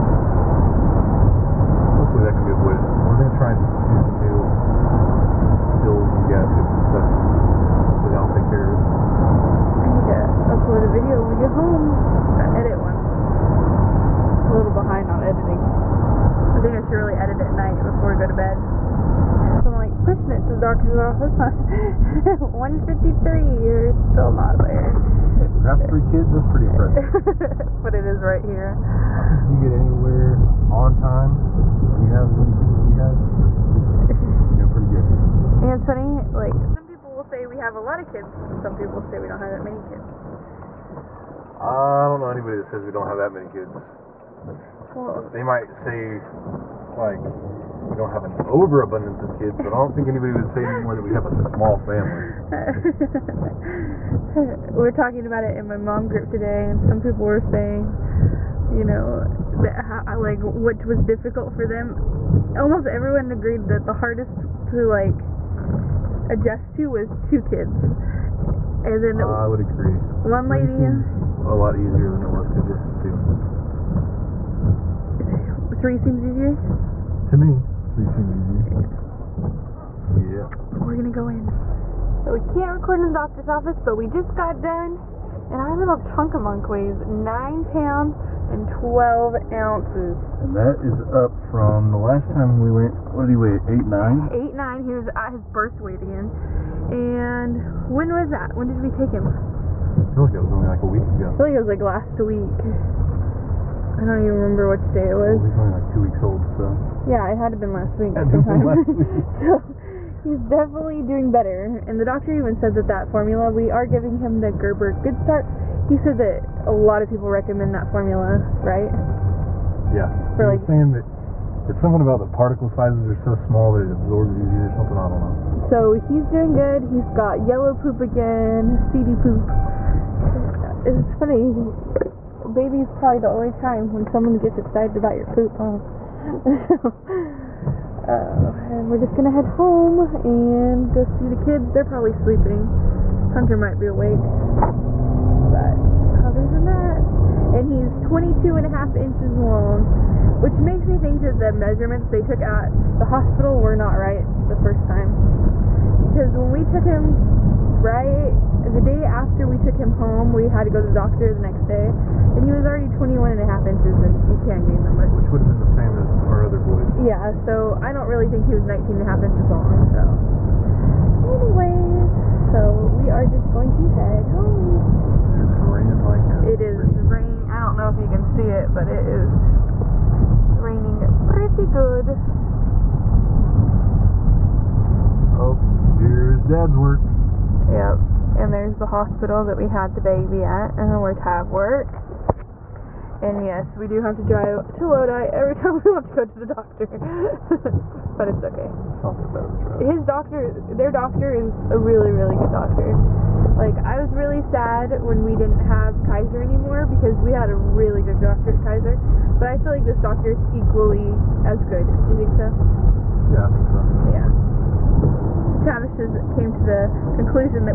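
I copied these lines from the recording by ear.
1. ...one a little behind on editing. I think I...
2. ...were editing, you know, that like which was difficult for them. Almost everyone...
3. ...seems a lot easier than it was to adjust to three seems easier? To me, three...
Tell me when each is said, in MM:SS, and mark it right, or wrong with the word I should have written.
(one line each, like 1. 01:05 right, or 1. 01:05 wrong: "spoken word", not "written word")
1. 00:12 right
2. 00:57 wrong: "saying", not "editing"
3. 01:10 right.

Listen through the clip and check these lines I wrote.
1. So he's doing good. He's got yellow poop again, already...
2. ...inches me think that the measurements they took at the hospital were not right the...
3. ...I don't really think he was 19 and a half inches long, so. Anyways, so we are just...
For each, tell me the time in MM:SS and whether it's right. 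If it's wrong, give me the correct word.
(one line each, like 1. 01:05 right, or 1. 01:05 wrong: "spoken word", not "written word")
1. 02:05 wrong: "seedy", not "already"
2. 02:30 wrong: "makes", not "inches"
3. 02:47 right.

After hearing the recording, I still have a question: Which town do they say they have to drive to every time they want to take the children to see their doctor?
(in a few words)
Lodi.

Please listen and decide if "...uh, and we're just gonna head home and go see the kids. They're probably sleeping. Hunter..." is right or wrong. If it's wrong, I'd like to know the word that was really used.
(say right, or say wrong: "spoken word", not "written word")
right.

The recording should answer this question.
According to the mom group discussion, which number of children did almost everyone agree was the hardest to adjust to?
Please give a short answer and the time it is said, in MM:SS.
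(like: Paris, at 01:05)
2, at 01:07.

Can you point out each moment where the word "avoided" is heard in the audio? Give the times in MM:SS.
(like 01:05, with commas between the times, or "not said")
00:02.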